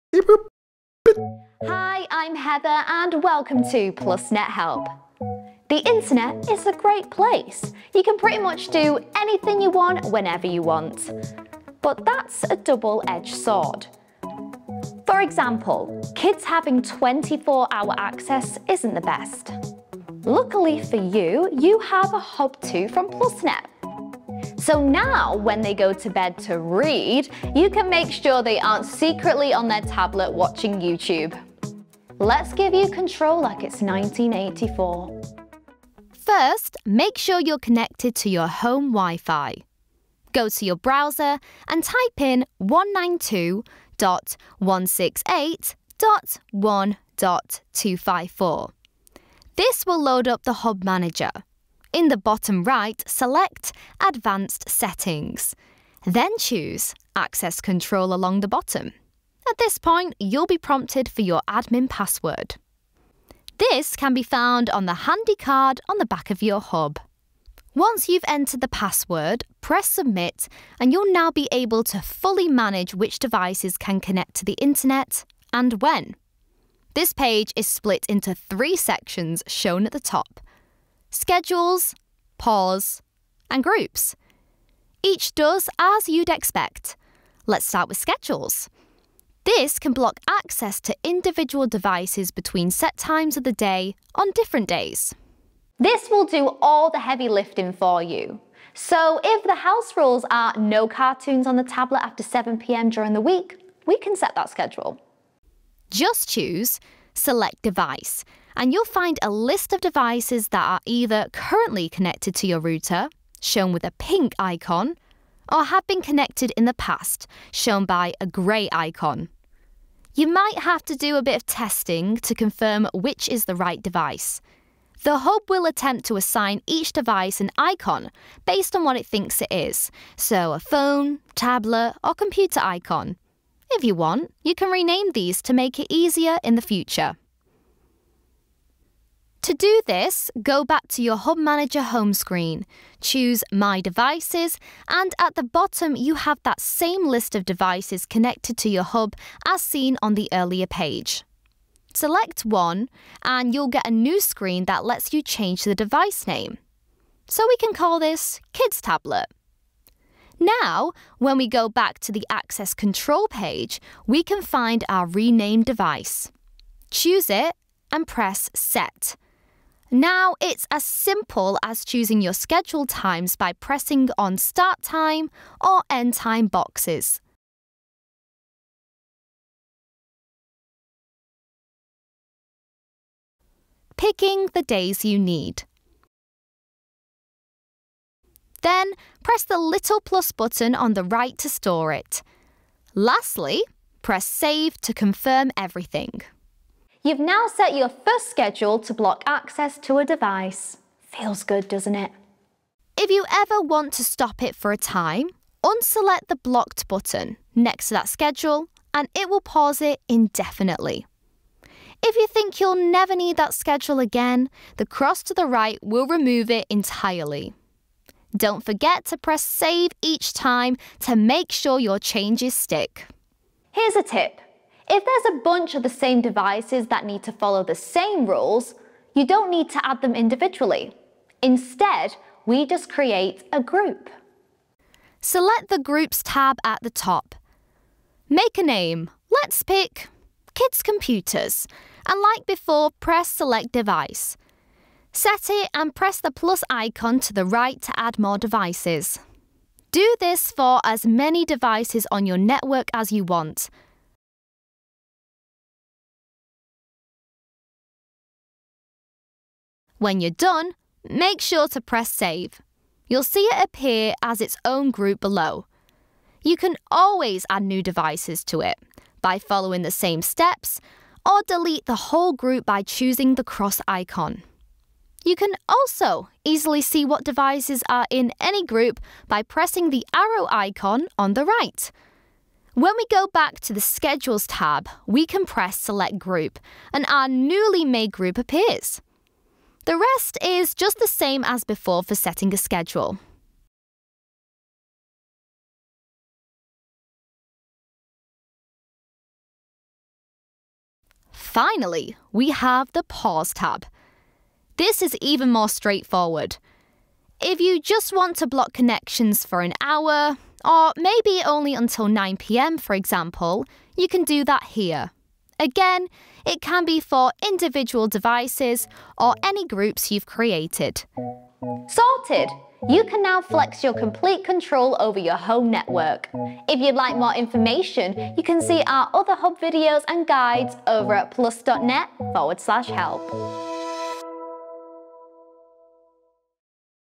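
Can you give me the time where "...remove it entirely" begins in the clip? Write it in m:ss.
3:36.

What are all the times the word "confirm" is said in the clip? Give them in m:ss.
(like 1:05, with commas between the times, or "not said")
2:02, 3:14.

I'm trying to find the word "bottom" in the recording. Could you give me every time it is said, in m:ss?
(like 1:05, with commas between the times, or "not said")
0:52, 0:58, 2:25.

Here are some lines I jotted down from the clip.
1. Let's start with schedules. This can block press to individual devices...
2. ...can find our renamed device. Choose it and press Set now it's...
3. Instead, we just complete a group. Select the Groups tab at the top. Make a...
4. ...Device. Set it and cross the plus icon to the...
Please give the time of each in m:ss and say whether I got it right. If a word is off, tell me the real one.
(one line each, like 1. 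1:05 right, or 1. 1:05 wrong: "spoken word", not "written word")
1. 1:27 wrong: "access", not "press"
2. 2:44 right
3. 3:51 wrong: "create", not "complete"
4. 4:03 wrong: "press", not "cross".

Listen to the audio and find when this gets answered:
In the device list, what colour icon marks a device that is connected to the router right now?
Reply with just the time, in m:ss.
1:53.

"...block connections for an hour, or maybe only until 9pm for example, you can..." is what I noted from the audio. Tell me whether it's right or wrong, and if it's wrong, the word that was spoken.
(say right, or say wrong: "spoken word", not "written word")
right.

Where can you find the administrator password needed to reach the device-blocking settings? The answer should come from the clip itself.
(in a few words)
card on the back of your hub.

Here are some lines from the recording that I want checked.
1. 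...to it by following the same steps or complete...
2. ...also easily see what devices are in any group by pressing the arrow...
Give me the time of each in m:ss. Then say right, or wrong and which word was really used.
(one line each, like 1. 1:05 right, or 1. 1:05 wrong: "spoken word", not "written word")
1. 4:28 wrong: "delete", not "complete"
2. 4:35 right.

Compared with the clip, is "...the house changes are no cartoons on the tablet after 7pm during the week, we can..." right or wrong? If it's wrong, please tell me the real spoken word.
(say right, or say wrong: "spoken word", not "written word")
wrong: "rules", not "changes".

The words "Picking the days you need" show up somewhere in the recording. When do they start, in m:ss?
3:03.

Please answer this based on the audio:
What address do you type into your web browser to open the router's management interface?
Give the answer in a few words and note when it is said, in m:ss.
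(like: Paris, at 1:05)
192.168.1.254, at 0:42.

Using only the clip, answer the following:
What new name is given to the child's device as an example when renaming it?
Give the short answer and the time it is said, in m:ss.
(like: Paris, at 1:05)
Kids Tablet, at 2:38.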